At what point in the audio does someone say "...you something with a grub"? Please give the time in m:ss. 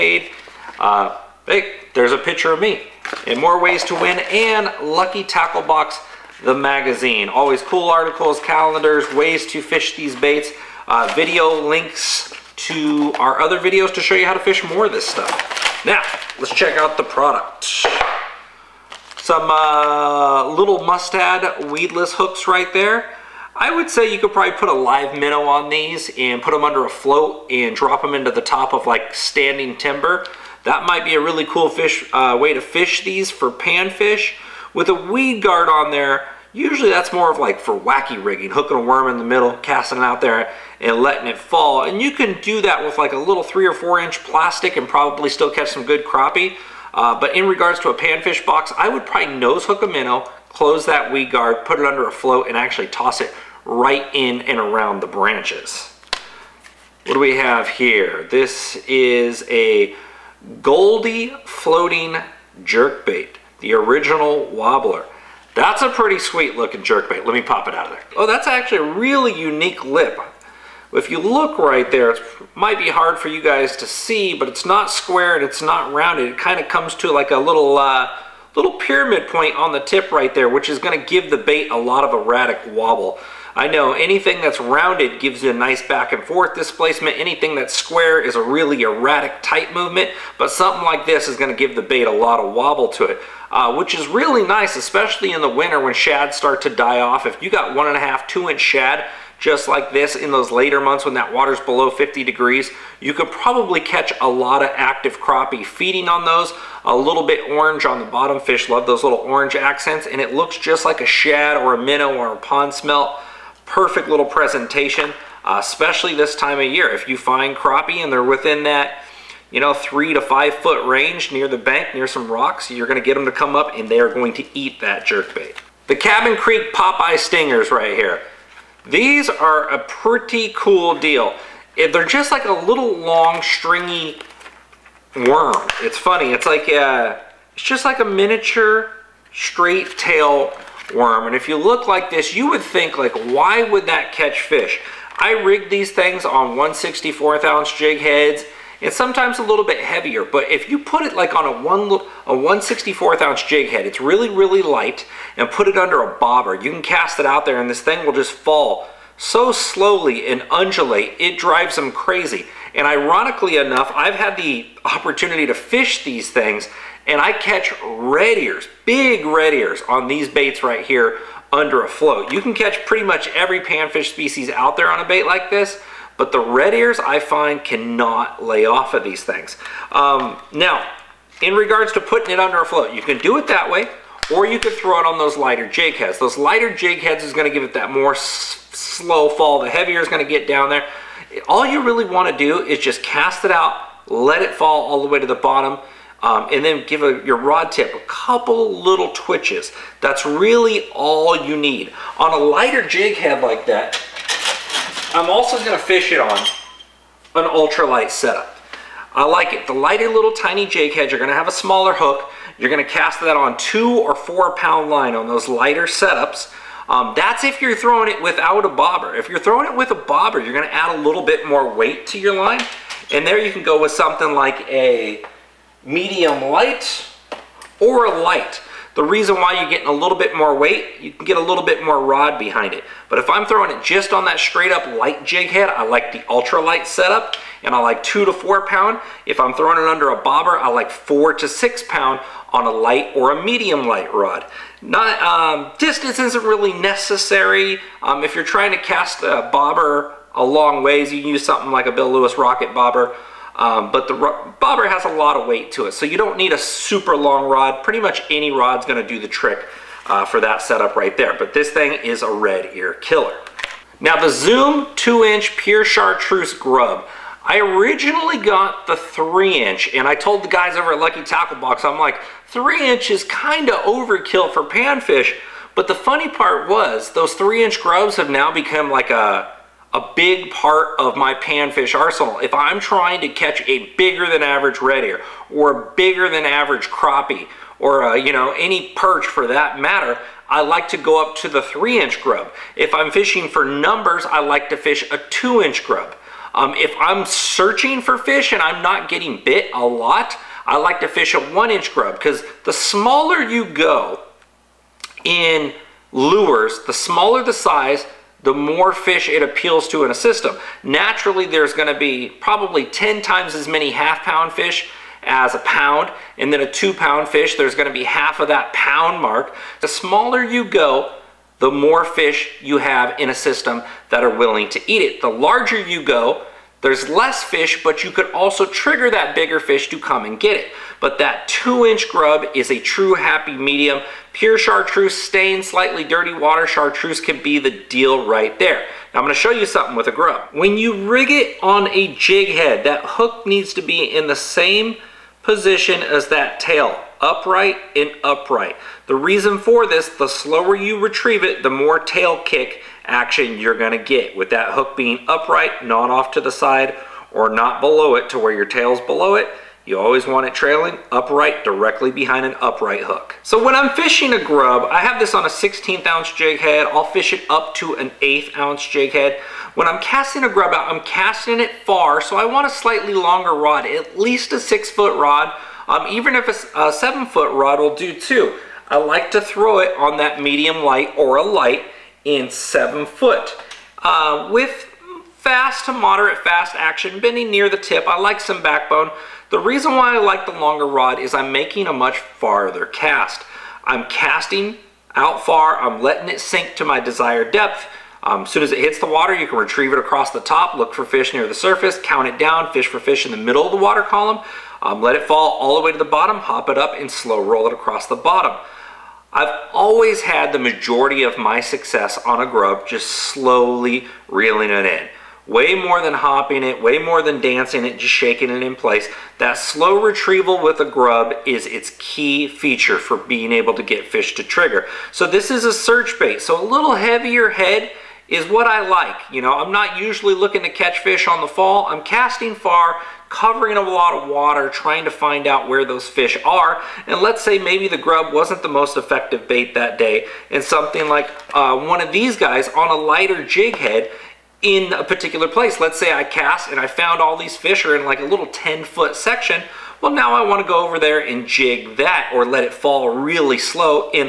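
5:39.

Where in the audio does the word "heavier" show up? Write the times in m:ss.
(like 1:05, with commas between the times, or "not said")
2:29, 3:09, 7:06.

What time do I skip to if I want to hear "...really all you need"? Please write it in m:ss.
3:20.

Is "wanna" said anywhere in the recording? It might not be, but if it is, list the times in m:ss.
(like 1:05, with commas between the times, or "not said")
3:12, 7:30.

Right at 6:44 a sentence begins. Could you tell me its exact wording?
Um, let it fall all the way to the bottom, hop it up, and slow roll it across the bottom.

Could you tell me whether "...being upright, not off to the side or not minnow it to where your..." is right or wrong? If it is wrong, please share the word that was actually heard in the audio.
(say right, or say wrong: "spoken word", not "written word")
wrong: "below", not "minnow".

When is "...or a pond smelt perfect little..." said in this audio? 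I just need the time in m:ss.
1:52.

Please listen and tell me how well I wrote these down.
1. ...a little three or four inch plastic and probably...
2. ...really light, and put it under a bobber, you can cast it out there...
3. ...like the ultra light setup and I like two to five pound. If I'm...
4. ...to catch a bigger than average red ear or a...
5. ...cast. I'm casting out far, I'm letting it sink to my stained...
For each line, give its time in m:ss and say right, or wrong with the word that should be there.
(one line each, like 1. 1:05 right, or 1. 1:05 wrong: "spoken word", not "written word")
1. 0:43 right
2. 2:34 right
3. 3:55 wrong: "four", not "five"
4. 4:43 right
5. 6:32 wrong: "desired", not "stained".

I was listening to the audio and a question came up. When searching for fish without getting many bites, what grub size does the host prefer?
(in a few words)
1 inch.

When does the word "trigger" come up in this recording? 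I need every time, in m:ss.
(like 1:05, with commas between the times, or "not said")
5:28, 7:04.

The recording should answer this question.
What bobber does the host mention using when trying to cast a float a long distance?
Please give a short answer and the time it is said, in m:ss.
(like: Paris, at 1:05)
Bill Lewis Rocket Bobber, at 4:11.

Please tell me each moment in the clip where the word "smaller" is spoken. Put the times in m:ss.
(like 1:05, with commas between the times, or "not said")
3:31, 5:02, 5:06, 5:19.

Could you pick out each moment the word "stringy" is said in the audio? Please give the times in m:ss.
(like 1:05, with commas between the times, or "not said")
2:13.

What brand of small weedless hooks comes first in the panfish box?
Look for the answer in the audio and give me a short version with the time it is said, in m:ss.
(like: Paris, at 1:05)
Mustad, at 0:20.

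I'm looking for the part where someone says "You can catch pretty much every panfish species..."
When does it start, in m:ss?
2:52.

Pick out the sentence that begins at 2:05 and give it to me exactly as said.
The Cabin Creek Popeye Stingers right here.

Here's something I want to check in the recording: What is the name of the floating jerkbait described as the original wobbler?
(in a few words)
Goldy.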